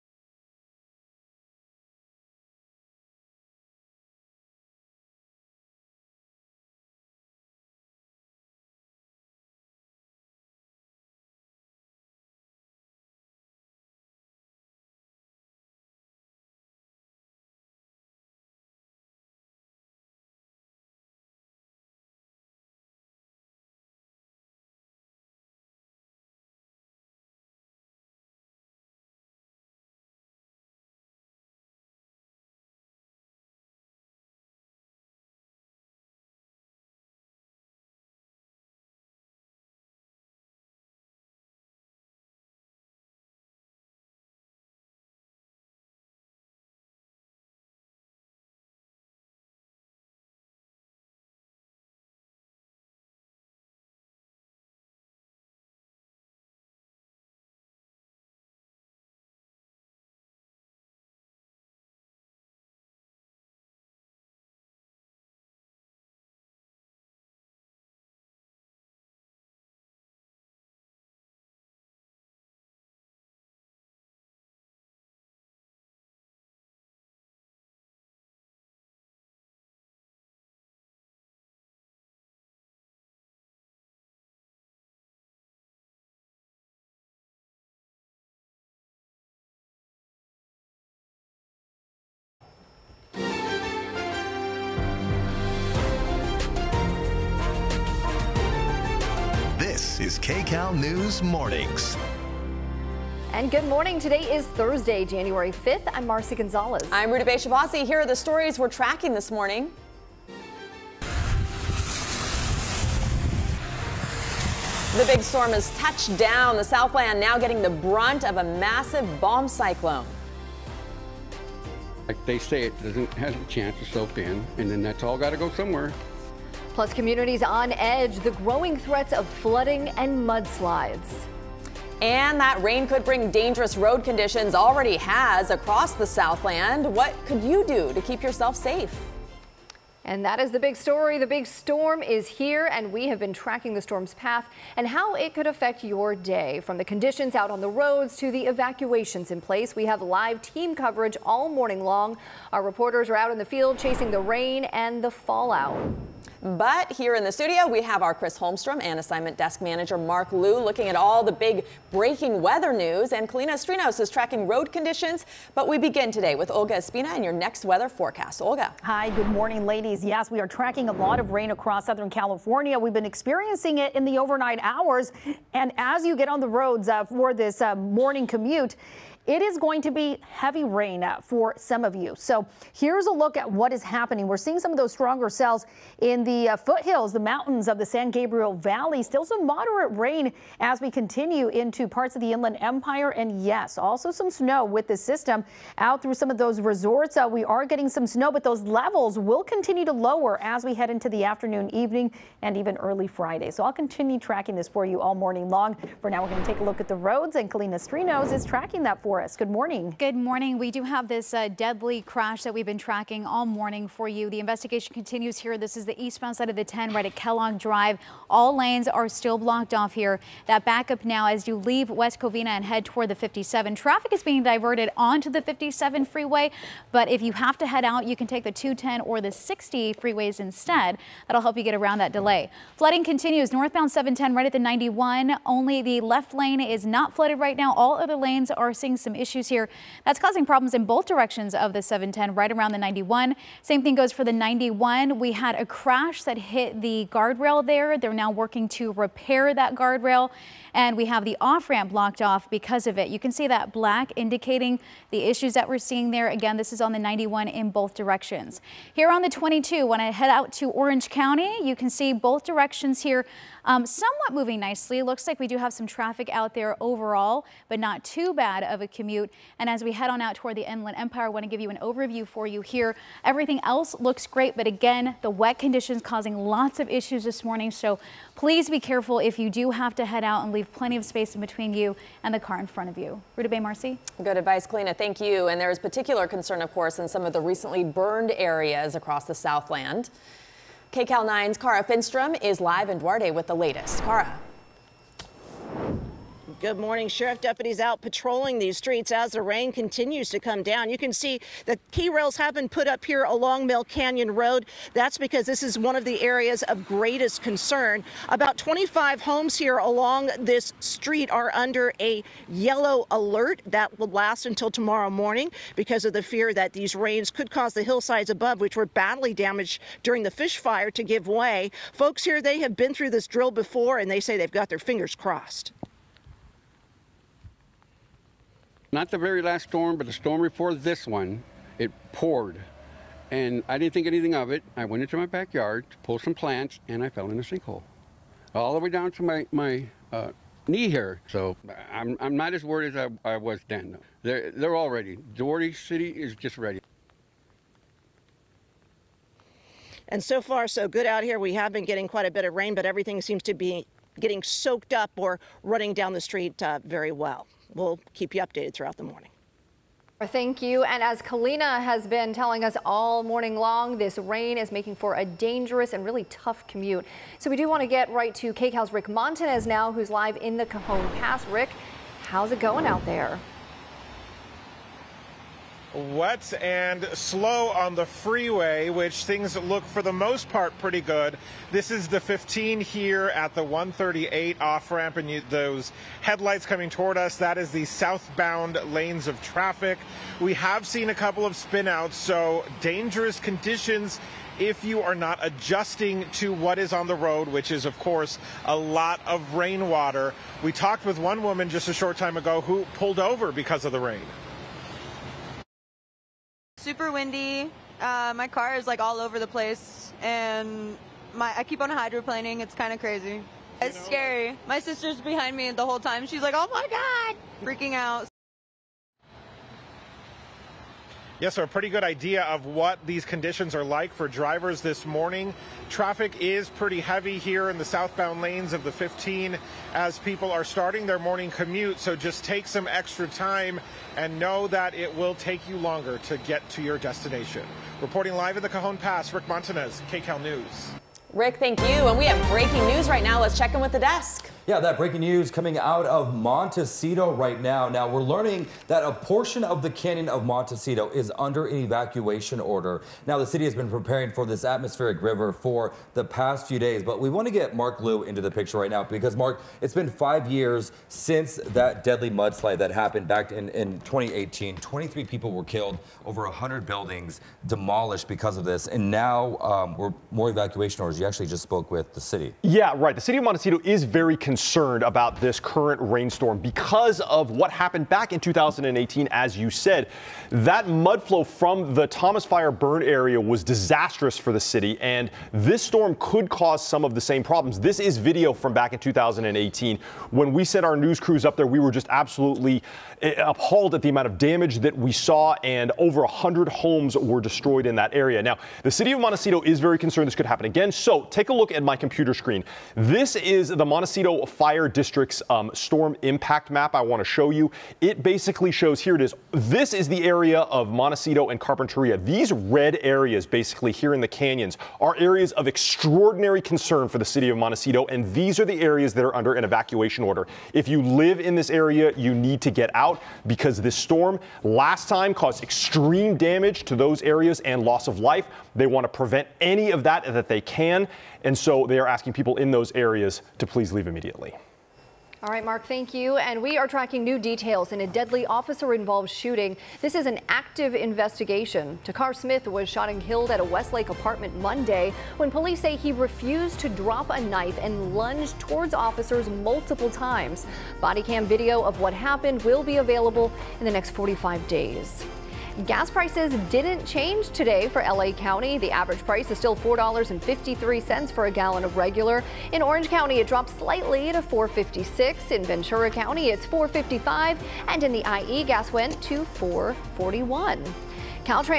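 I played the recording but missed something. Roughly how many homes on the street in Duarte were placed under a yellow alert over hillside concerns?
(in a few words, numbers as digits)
25.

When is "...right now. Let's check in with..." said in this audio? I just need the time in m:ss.
7:23.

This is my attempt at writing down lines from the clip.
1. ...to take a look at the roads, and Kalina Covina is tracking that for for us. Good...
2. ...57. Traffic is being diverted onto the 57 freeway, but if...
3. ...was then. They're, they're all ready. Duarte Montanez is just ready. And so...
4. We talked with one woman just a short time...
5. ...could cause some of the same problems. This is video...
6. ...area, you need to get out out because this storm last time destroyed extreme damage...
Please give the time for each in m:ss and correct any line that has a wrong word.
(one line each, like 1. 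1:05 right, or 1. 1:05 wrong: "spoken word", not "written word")
1. 3:26 wrong: "Strinos", not "Covina"
2. 3:43 right
3. 5:43 wrong: "City", not "Montanez"
4. 6:40 right
5. 8:06 right
6. 8:41 wrong: "caused", not "destroyed".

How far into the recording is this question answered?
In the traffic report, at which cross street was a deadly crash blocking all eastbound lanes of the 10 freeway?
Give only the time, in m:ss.
3:37.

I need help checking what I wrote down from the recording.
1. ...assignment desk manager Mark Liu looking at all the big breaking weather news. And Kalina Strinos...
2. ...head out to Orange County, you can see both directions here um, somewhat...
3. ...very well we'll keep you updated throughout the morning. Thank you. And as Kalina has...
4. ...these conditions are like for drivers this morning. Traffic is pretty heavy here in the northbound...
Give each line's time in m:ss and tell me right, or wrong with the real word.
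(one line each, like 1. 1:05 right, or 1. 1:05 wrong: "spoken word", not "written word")
1. 2:38 right
2. 4:20 right
3. 5:56 right
4. 7:03 wrong: "southbound", not "northbound".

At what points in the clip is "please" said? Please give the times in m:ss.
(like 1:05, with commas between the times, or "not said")
4:38, 8:53.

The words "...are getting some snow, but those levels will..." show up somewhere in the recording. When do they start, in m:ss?
3:17.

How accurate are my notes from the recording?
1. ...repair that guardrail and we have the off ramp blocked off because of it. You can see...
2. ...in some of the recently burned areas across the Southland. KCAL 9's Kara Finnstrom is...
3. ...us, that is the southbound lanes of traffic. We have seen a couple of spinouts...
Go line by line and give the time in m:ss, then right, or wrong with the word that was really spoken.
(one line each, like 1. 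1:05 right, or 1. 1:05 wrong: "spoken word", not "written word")
1. 4:08 right
2. 4:46 right
3. 6:27 right.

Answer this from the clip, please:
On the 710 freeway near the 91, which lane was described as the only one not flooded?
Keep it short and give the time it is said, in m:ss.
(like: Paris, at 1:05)
The left lane, at 3:56.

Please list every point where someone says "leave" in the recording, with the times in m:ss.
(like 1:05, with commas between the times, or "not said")
3:41, 4:40, 8:53.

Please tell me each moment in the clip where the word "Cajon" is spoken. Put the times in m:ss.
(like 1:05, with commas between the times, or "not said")
6:10, 7:18.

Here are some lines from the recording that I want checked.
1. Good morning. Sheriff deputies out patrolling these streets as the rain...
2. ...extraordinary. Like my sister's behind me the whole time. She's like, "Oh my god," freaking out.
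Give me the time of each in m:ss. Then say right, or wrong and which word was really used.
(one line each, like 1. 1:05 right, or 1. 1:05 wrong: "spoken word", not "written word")
1. 4:56 right
2. 6:54 wrong: "scary", not "extraordinary".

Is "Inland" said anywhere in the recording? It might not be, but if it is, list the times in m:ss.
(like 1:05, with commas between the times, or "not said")
3:12, 4:30.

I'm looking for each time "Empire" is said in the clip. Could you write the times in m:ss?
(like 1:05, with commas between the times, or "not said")
3:12, 4:30.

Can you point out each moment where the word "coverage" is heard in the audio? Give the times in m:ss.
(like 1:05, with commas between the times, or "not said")
2:30.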